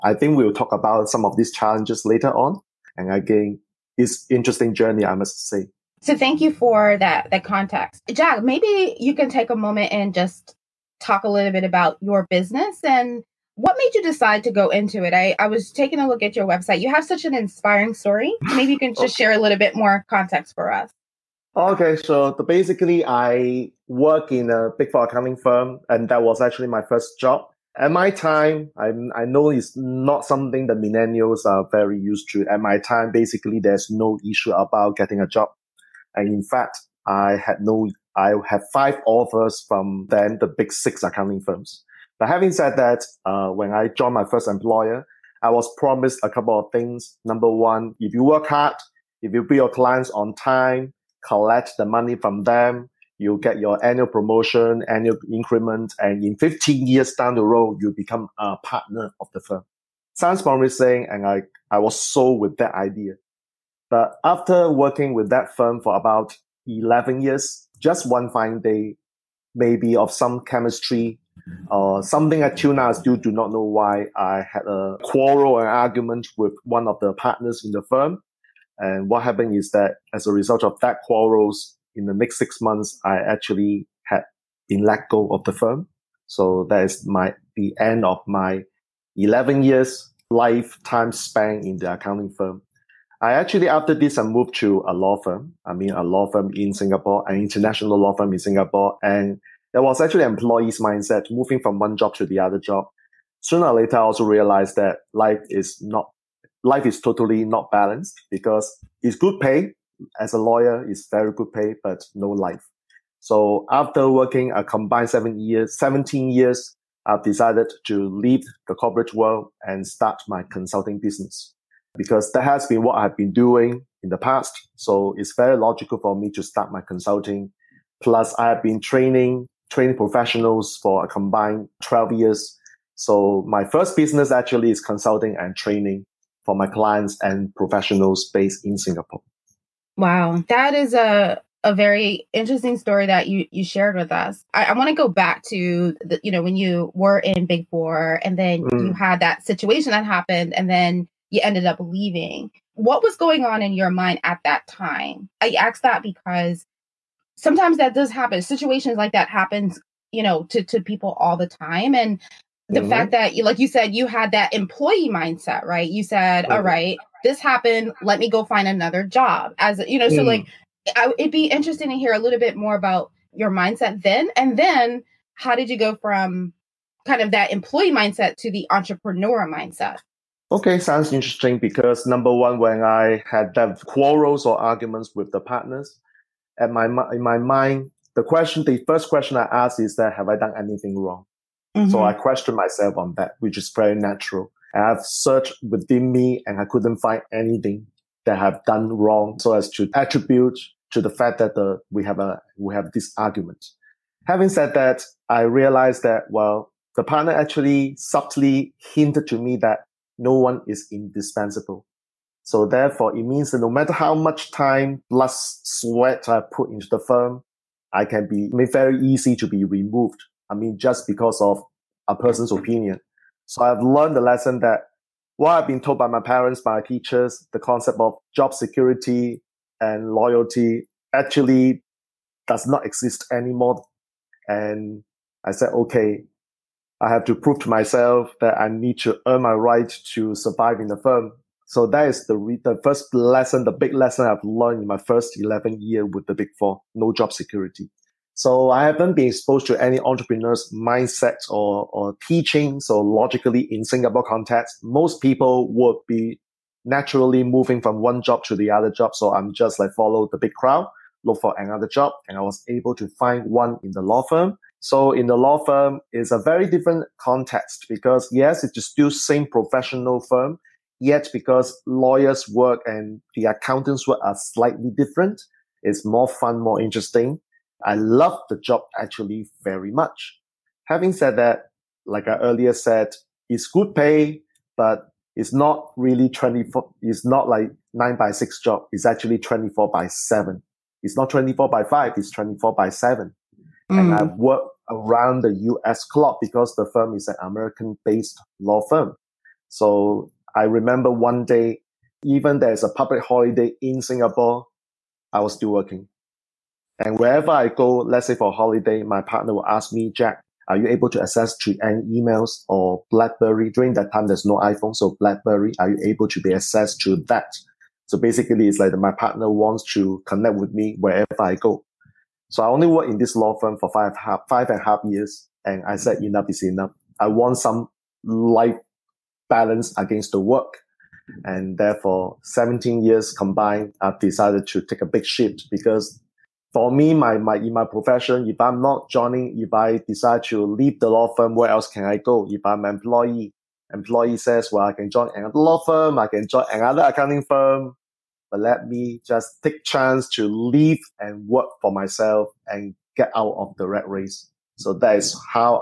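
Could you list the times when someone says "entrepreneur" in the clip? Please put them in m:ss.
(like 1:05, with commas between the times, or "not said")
2:58, 4:09.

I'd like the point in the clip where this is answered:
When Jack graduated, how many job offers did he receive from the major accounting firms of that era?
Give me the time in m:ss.
0:38.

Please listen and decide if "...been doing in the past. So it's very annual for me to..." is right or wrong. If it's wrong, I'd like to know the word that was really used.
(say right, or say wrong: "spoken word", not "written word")
wrong: "logical", not "annual".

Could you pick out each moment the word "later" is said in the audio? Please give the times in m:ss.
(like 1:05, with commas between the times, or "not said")
0:02, 1:43.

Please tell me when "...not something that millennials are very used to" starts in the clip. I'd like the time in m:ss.
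0:29.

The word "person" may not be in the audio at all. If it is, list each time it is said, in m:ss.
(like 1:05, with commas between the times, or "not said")
3:42.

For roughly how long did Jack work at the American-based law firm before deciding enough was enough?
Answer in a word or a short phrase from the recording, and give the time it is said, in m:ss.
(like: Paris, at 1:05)
5.5 years, at 5:24.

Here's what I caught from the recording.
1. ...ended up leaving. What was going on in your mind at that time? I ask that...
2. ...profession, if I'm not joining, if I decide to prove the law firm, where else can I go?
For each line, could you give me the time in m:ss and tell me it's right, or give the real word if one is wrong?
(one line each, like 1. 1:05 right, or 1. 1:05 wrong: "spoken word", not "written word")
1. 2:31 right
2. 5:37 wrong: "leave", not "prove".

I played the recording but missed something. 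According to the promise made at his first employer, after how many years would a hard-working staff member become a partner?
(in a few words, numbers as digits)
15.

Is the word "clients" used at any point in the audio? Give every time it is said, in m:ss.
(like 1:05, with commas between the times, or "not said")
0:49, 2:16.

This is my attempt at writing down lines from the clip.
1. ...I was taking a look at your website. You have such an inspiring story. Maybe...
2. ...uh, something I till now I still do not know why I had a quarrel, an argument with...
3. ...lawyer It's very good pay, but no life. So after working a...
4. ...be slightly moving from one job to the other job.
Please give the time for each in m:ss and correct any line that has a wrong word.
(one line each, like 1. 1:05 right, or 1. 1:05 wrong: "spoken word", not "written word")
1. 0:15 right
2. 1:11 right
3. 1:50 right
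4. 4:16 wrong: "naturally", not "slightly".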